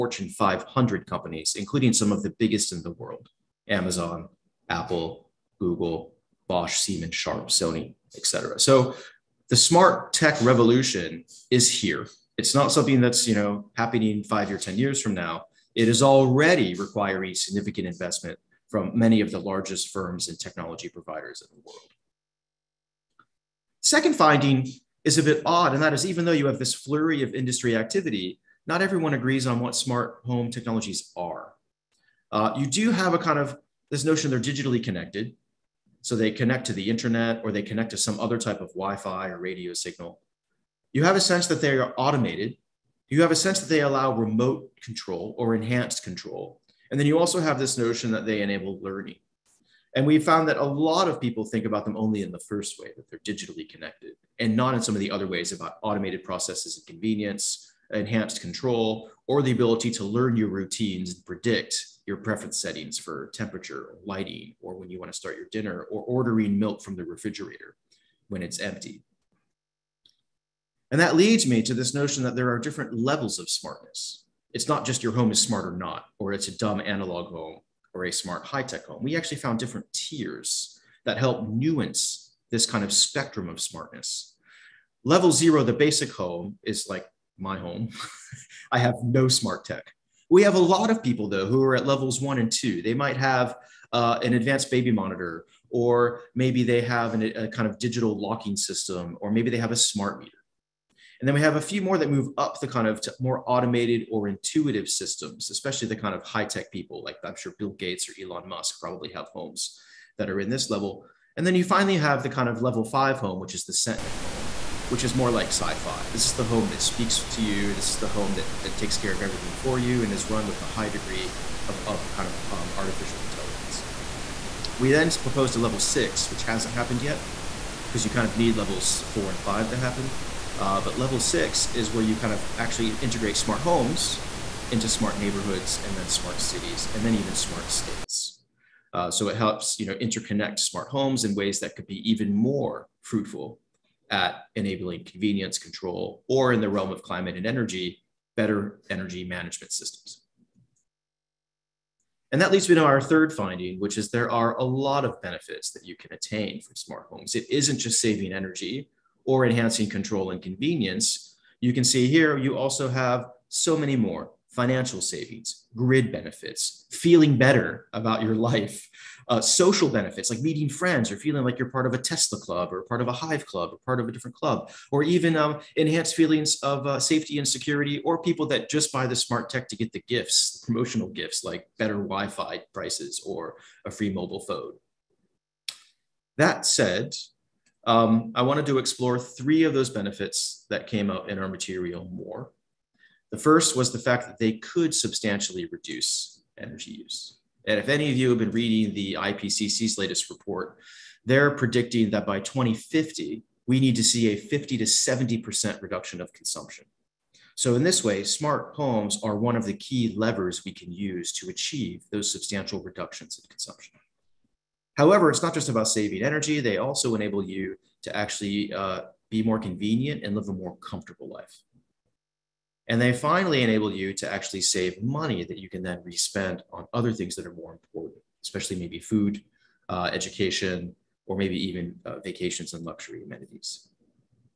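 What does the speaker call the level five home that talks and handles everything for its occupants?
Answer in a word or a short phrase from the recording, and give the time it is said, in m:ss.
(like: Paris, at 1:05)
Sentinel home, at 1:53.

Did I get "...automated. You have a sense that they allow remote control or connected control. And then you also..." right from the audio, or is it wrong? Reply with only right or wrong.
wrong.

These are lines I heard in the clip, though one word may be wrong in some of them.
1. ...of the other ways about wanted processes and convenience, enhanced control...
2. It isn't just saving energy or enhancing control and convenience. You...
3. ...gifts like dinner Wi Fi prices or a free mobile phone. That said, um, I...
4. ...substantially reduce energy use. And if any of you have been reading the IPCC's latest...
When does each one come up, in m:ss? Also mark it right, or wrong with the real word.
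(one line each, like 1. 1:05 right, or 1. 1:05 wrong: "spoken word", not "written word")
1. 0:54 wrong: "automated", not "wanted"
2. 2:37 right
3. 3:01 wrong: "better", not "dinner"
4. 3:14 right.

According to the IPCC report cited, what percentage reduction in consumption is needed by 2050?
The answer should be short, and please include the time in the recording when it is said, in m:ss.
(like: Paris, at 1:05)
50 to 70%, at 3:24.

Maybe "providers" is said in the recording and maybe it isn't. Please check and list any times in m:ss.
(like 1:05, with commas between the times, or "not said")
0:20.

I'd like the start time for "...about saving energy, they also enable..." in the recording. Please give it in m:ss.
3:35.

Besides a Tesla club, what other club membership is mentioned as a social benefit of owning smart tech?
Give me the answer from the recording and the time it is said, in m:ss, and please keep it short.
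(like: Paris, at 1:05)
Hive club, at 2:53.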